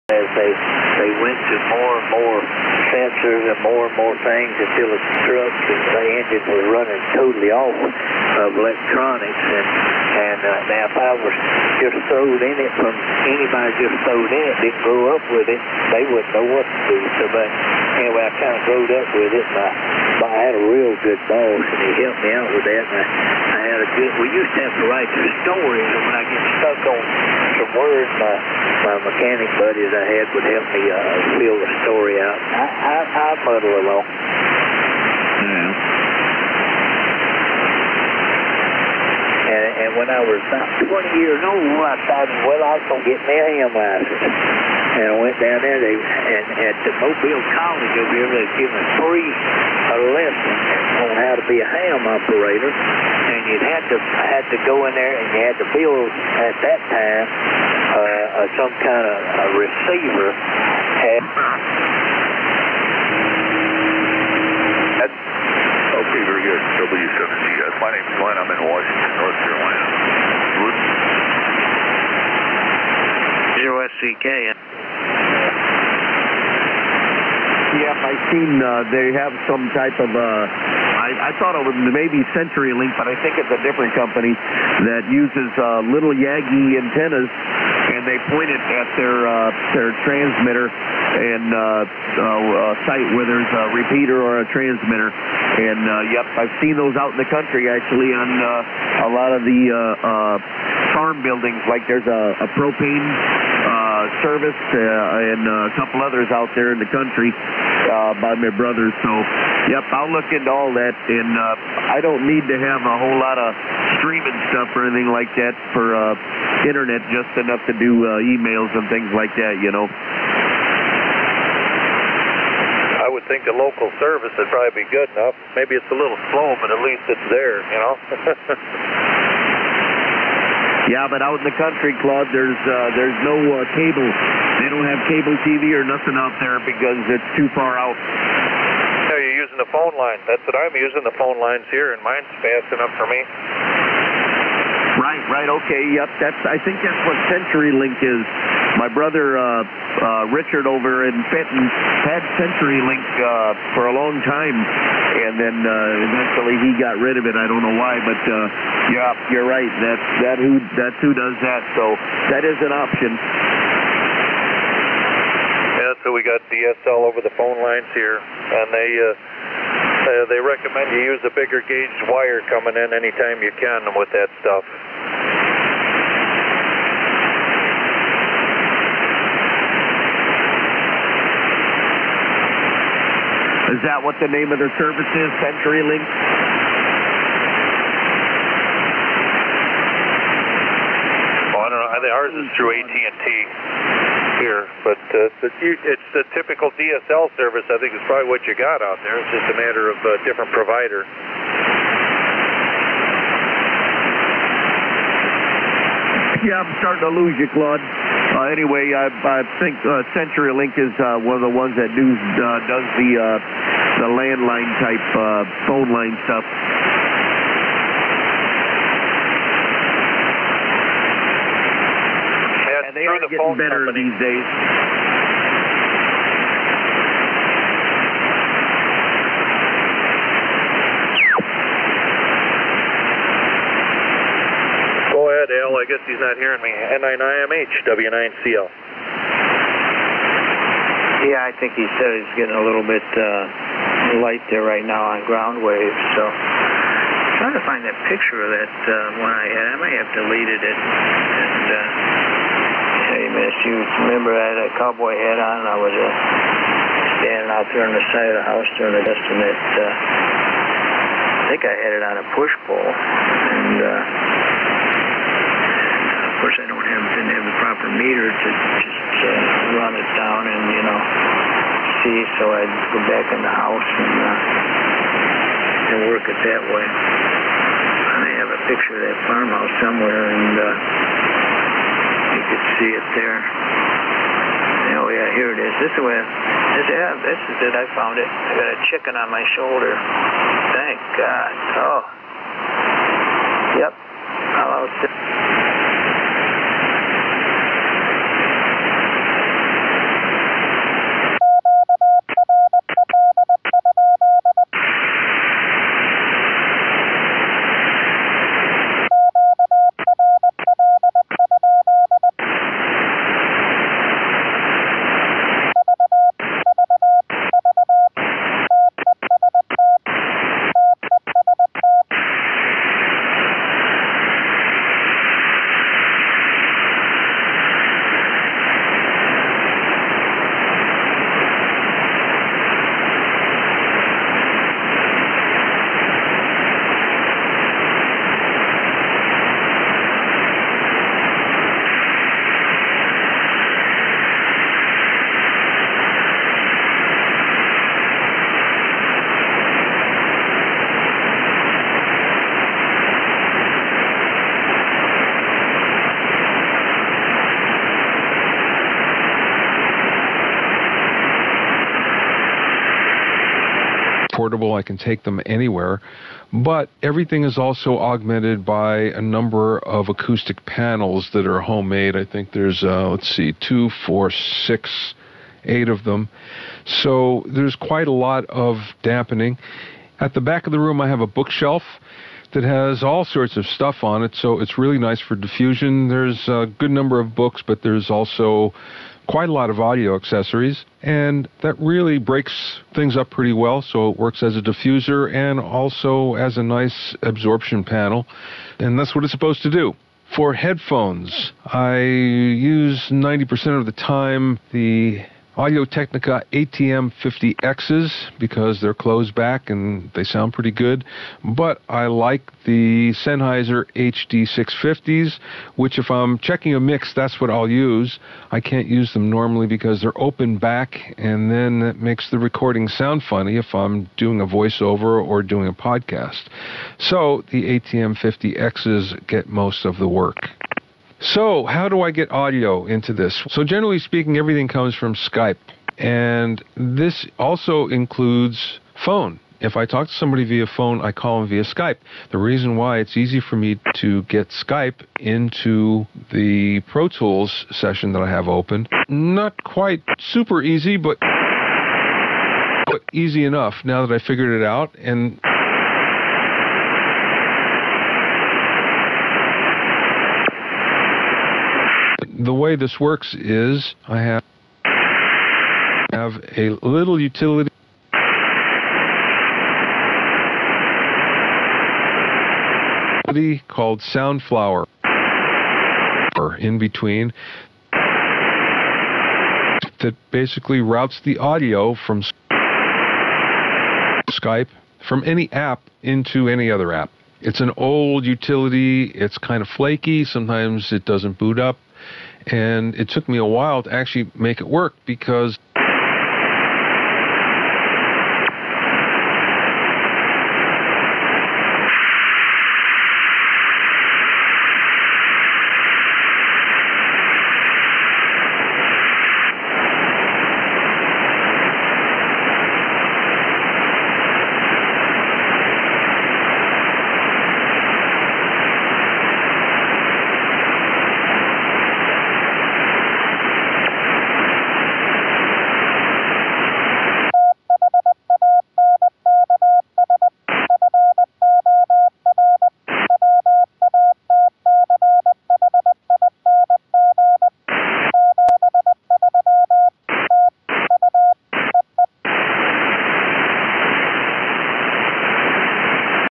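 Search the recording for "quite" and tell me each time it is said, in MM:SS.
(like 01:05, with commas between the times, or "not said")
06:17, 06:29, 07:29.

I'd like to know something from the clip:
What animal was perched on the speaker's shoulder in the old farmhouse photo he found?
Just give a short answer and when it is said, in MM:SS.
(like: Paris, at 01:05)
A chicken, at 04:48.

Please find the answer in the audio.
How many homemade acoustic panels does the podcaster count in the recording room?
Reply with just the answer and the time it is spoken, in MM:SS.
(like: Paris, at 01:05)
8, at 06:15.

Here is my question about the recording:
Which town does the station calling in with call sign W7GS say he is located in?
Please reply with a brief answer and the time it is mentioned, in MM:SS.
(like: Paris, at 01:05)
Washington, North Carolina, at 01:08.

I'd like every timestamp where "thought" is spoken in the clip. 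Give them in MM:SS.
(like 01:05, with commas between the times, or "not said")
00:42, 01:21.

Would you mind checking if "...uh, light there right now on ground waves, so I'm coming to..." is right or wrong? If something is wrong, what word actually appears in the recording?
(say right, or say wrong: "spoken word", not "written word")
wrong: "trying", not "coming".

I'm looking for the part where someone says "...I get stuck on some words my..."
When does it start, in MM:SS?
00:26.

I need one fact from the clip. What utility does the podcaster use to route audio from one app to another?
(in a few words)
Soundflower.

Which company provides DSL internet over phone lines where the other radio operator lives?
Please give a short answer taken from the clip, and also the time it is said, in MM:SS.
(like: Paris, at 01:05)
AT&T, at 03:12.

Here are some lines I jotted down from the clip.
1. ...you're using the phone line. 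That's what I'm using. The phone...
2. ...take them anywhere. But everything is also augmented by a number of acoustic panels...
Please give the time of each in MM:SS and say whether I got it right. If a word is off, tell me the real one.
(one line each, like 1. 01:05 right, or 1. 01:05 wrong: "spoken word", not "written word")
1. 02:19 right
2. 06:04 right.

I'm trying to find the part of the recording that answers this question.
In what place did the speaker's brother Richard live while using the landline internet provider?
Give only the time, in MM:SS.
02:31.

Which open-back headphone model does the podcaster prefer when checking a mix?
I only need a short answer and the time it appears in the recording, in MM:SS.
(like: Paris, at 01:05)
Sennheiser HD 650, at 06:53.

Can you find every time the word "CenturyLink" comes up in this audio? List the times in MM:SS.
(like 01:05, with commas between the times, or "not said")
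01:22, 02:27, 02:32, 03:05, 03:30.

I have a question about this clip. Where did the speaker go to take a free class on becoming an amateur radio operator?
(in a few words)
Mobile College.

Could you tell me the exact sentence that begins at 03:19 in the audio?
It's just a matter of a different provider.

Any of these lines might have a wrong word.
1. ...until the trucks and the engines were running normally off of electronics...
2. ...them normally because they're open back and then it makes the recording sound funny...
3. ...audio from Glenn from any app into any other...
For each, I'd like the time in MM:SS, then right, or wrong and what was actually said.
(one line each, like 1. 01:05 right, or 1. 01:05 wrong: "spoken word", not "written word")
1. 00:04 wrong: "totally", not "normally"
2. 06:59 right
3. 08:01 wrong: "Skype", not "Glenn".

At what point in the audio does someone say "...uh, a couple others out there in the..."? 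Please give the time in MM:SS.
01:45.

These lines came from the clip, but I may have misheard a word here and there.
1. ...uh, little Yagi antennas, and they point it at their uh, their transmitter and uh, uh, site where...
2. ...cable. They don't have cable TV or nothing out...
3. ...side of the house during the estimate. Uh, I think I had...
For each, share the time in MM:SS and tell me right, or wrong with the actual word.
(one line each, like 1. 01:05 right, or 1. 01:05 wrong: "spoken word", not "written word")
1. 01:25 right
2. 02:13 right
3. 04:18 right.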